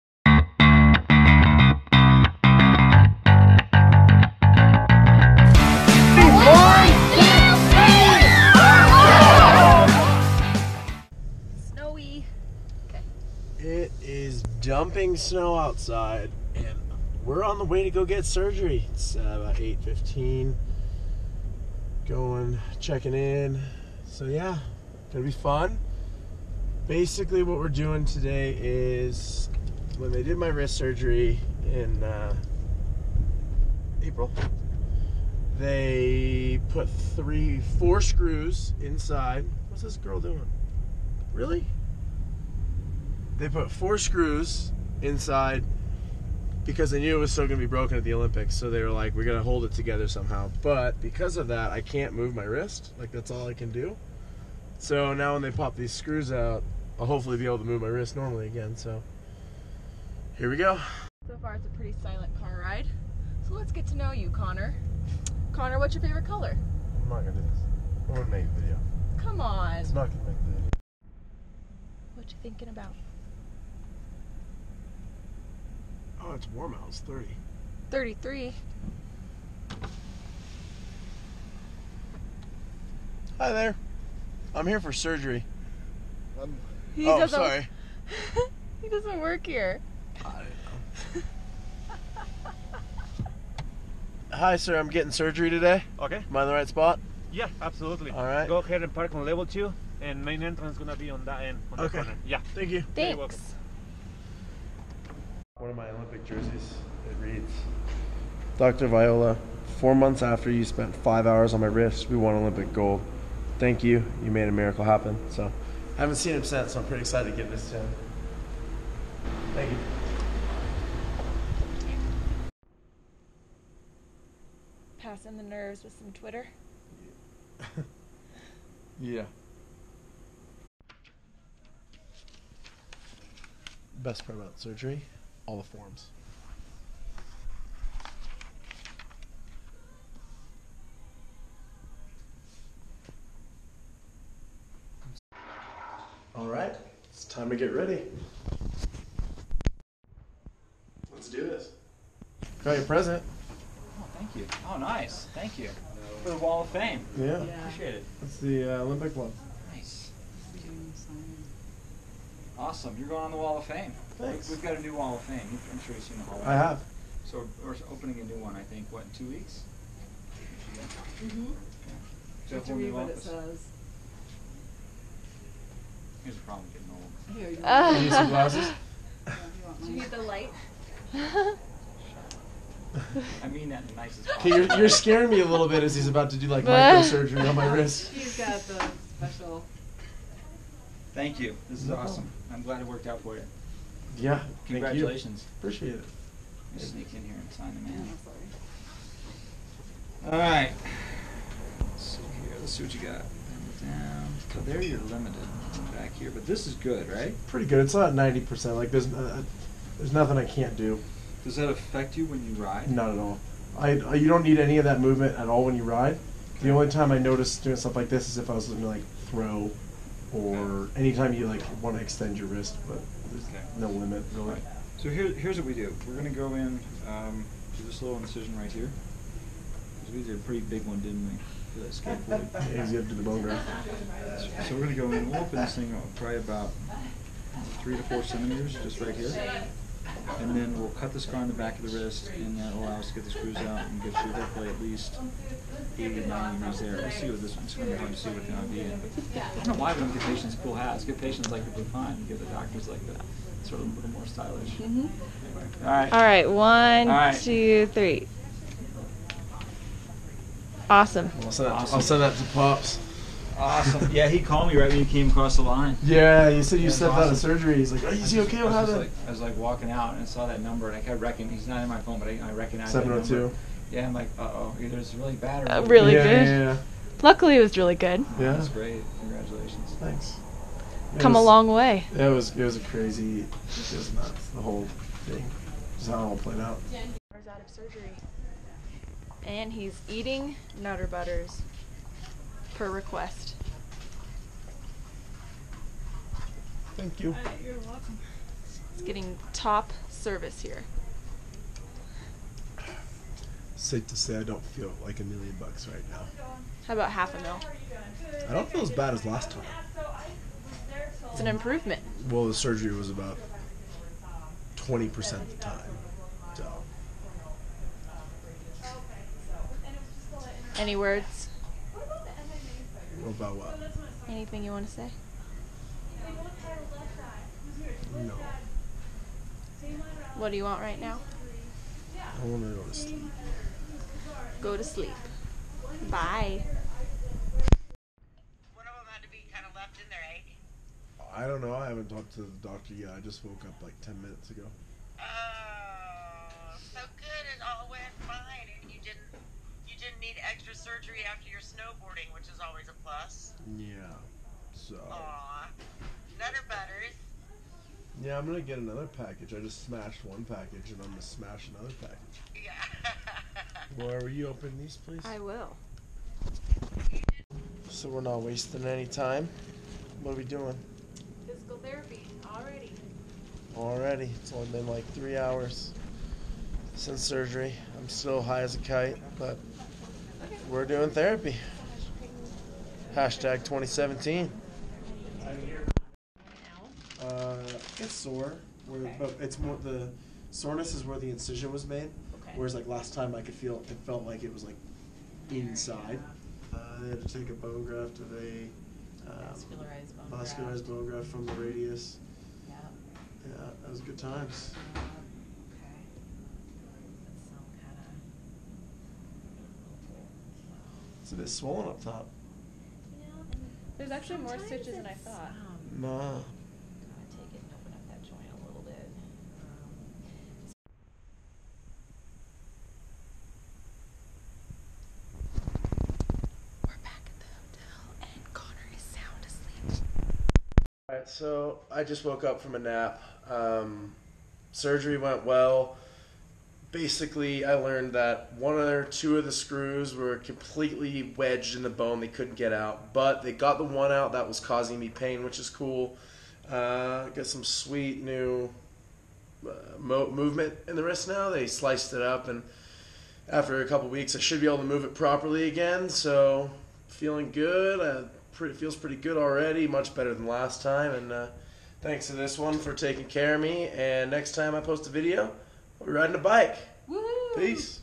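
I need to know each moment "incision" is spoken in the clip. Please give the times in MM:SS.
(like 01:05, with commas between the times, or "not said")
03:48, 06:31.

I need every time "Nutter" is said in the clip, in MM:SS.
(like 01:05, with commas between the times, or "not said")
04:50, 05:56.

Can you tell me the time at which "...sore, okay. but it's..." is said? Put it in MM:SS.
06:28.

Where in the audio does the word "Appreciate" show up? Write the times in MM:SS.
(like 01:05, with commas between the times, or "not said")
02:37, 03:15.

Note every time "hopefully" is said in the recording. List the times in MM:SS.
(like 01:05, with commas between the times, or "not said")
00:57, 04:04.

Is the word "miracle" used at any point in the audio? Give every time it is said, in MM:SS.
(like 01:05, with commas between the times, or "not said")
01:54.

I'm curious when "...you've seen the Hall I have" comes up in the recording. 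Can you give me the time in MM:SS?
02:45.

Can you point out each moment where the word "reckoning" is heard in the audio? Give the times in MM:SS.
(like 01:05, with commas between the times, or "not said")
04:31.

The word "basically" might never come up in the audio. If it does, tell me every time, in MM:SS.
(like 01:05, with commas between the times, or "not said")
00:26, 07:16.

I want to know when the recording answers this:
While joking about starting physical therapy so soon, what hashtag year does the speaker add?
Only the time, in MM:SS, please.
06:23.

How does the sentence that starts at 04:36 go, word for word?
Yeah, yeah, Luckily, it was really good.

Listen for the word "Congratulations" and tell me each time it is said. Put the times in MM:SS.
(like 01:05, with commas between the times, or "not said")
03:14, 04:39.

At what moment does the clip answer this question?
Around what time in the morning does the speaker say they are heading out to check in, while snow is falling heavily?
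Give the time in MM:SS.
00:19.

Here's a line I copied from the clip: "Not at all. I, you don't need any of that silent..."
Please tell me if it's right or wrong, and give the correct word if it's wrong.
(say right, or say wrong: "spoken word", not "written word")
wrong: "movement", not "silent".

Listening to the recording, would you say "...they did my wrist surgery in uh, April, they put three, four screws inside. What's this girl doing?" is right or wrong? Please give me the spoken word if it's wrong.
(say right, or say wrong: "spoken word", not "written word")
right.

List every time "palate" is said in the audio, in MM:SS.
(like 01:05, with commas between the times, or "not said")
not said.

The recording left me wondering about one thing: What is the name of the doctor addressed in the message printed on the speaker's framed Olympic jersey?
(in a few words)
Dr. Viola.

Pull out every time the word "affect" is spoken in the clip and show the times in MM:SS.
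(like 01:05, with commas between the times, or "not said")
03:31.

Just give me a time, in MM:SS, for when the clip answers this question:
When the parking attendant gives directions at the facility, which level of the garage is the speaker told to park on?
01:39.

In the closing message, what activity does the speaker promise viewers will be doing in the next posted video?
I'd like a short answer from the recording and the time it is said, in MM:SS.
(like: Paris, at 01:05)
Riding a bike, at 07:46.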